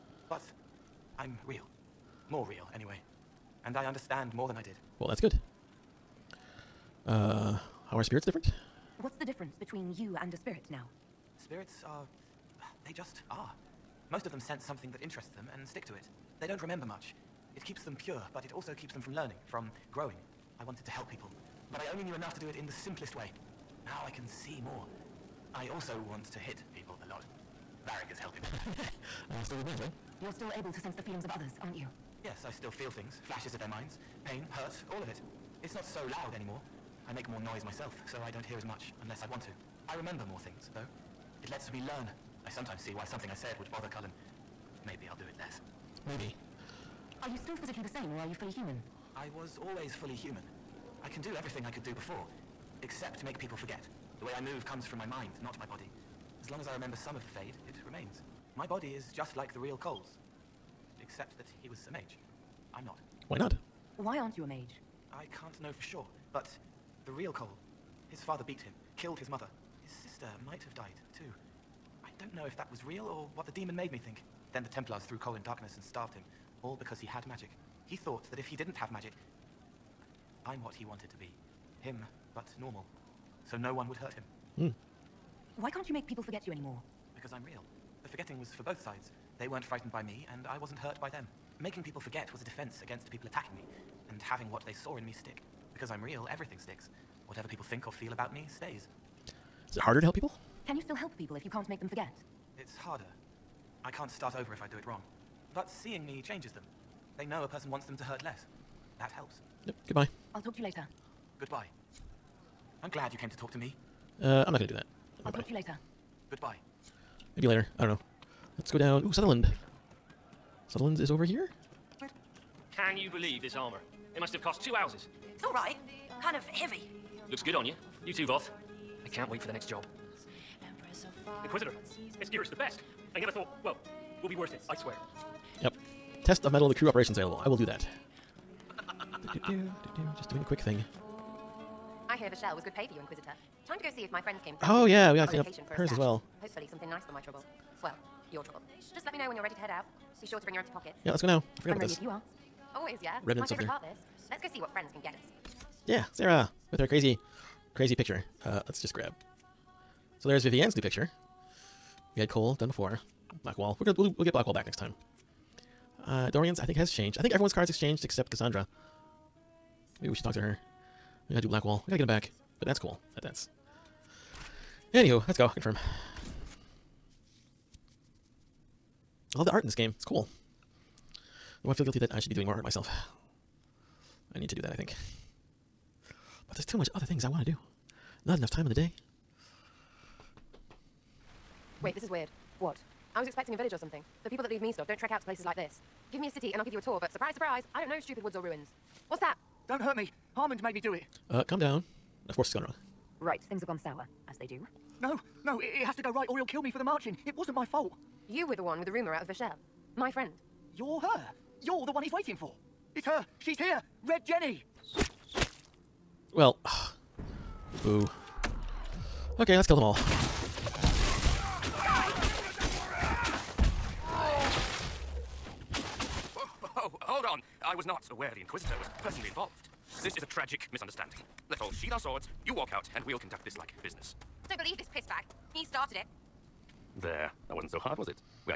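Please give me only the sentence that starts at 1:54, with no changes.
Uh, I'm not going to do that.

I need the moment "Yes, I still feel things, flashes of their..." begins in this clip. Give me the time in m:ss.
0:32.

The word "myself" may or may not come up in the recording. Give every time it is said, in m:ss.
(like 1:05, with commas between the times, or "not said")
0:37, 3:02.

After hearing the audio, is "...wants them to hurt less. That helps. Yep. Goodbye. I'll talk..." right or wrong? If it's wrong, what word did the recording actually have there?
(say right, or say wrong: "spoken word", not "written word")
right.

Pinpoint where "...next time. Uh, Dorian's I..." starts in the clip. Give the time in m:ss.
2:44.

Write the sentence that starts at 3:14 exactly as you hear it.
The people that leave me stuff don't trek out to places like this.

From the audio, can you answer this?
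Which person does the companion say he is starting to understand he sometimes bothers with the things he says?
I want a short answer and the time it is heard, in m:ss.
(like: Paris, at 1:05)
Cullen, at 0:43.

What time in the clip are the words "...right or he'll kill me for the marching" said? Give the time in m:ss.
3:26.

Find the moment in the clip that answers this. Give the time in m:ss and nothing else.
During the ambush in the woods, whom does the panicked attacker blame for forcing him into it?
3:20.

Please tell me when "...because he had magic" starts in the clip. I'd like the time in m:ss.
1:16.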